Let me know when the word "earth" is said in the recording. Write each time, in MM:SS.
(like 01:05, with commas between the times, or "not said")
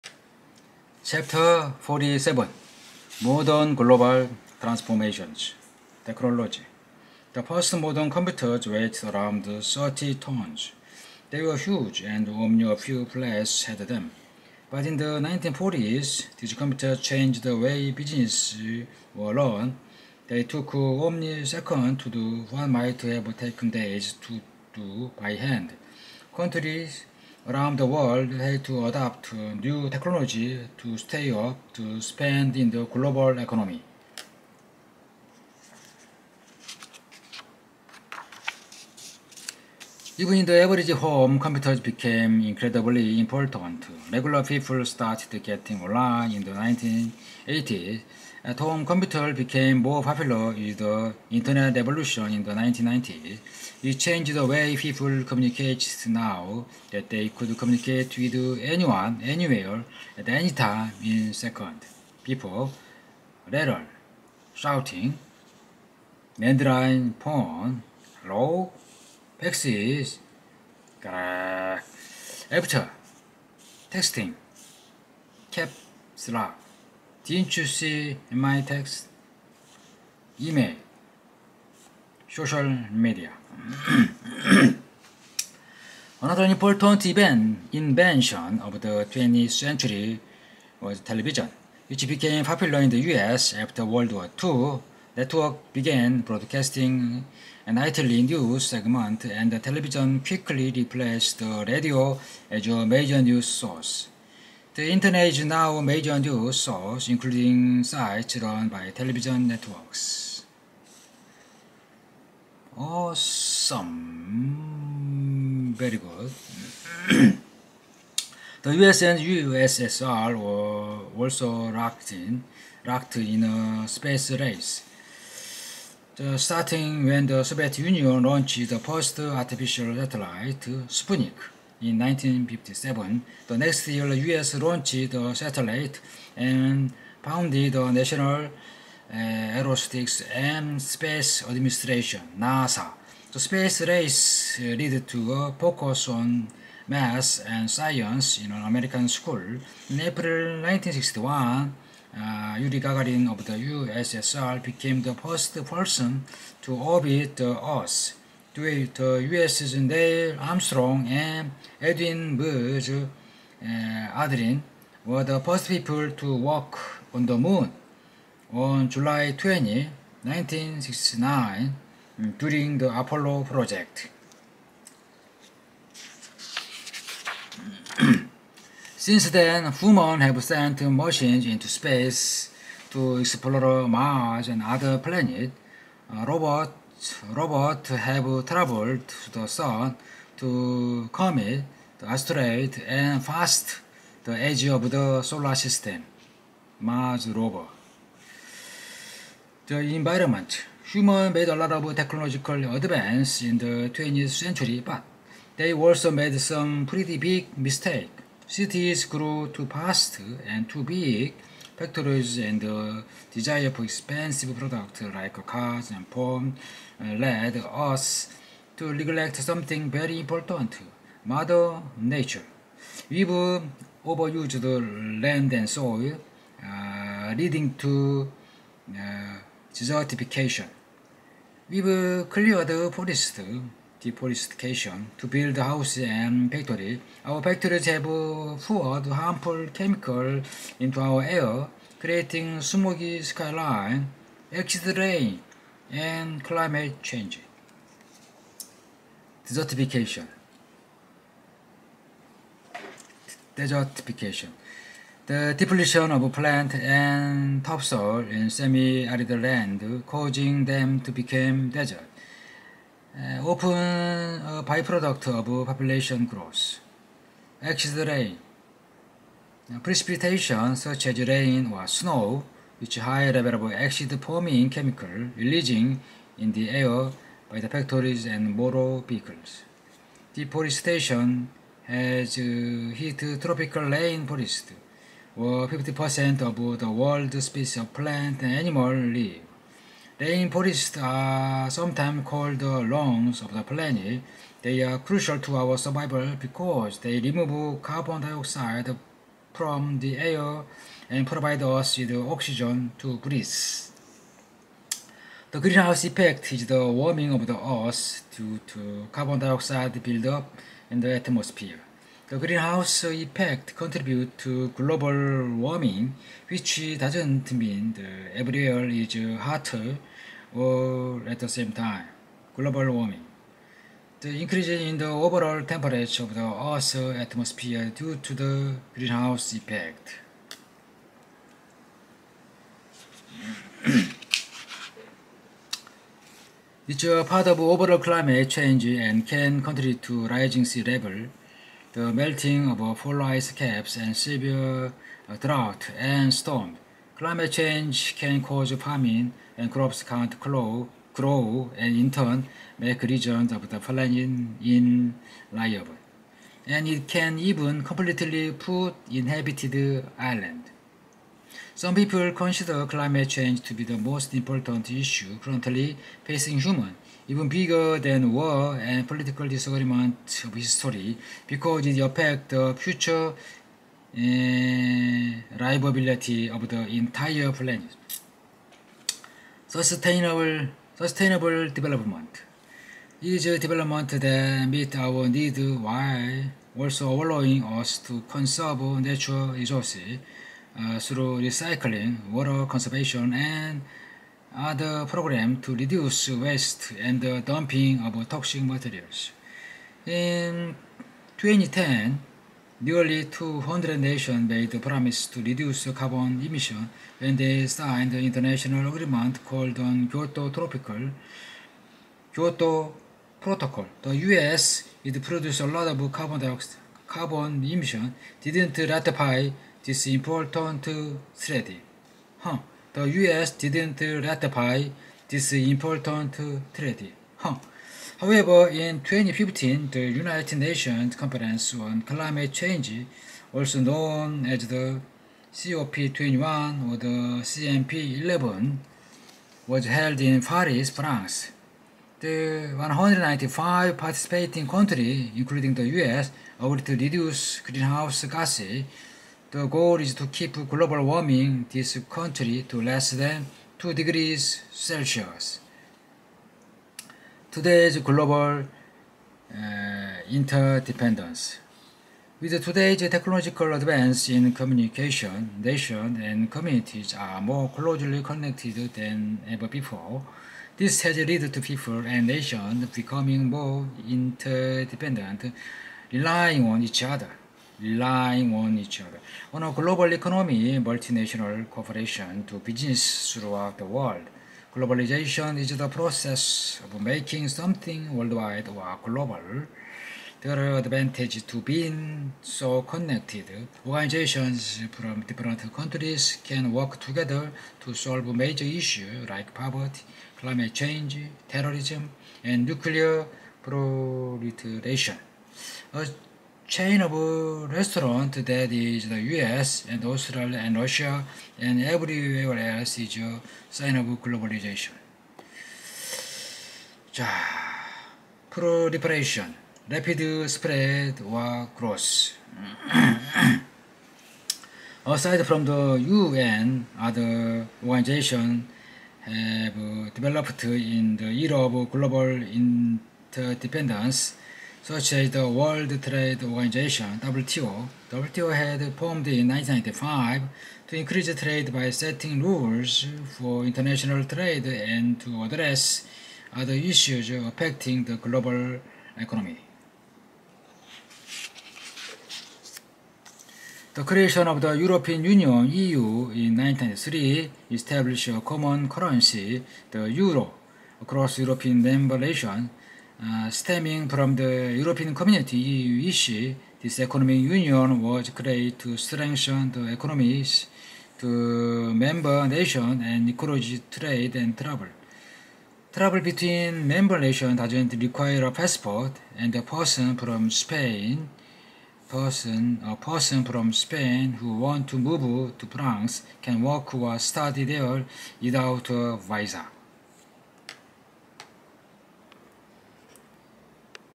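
02:37, 05:07, 05:26.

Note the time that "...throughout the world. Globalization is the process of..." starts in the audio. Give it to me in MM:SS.
08:03.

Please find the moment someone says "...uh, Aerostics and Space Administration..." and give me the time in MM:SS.
02:18.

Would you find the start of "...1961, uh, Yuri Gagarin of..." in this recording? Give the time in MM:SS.
02:30.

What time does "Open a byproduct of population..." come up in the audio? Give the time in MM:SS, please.
04:23.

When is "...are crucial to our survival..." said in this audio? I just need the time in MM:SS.
04:54.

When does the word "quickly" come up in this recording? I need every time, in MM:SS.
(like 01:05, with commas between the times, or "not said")
01:40.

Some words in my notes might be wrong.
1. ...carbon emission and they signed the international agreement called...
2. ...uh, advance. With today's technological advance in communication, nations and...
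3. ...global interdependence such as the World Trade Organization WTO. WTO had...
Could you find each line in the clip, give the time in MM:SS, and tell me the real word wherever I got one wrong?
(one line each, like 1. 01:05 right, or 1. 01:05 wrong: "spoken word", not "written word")
1. 06:45 right
2. 07:39 wrong: "interdependence", not "advance"
3. 08:51 right.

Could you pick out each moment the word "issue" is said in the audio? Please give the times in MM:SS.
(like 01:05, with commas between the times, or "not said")
06:04, 08:18, 09:06, 09:26.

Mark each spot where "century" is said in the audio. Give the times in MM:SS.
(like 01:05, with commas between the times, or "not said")
01:29, 03:24.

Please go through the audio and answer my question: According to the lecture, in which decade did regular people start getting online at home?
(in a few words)
1980s.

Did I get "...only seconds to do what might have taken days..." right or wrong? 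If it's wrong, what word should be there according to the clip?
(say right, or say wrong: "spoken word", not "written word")
right.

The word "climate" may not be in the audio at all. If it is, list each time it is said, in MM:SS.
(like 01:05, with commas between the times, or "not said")
04:06, 05:37, 05:47, 06:02, 07:12, 08:20.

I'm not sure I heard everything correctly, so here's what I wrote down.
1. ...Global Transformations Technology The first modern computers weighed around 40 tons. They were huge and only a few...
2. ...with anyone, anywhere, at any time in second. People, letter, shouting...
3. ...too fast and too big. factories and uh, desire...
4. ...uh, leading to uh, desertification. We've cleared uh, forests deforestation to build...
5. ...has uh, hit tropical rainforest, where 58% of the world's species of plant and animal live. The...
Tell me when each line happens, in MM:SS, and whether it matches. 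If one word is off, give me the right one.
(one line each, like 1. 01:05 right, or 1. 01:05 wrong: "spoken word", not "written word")
1. 00:03 wrong: "30", not "40"
2. 00:58 right
3. 03:29 right
4. 03:46 right
5. 04:41 wrong: "50", not "58".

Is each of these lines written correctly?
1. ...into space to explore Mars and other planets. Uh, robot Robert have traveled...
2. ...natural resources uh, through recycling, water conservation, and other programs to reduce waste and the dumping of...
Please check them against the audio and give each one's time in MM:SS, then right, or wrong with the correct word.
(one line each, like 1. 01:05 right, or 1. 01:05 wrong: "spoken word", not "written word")
1. 03:01 right
2. 06:28 right.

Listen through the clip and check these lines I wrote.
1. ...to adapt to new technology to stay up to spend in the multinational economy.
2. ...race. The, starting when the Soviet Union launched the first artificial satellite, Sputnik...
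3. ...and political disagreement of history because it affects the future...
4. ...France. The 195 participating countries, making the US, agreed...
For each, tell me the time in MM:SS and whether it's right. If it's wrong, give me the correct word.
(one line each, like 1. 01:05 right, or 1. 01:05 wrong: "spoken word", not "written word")
1. 00:28 wrong: "global", not "multinational"
2. 02:04 right
3. 06:08 right
4. 07:20 wrong: "including", not "making".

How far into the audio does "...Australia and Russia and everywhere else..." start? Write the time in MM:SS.
08:30.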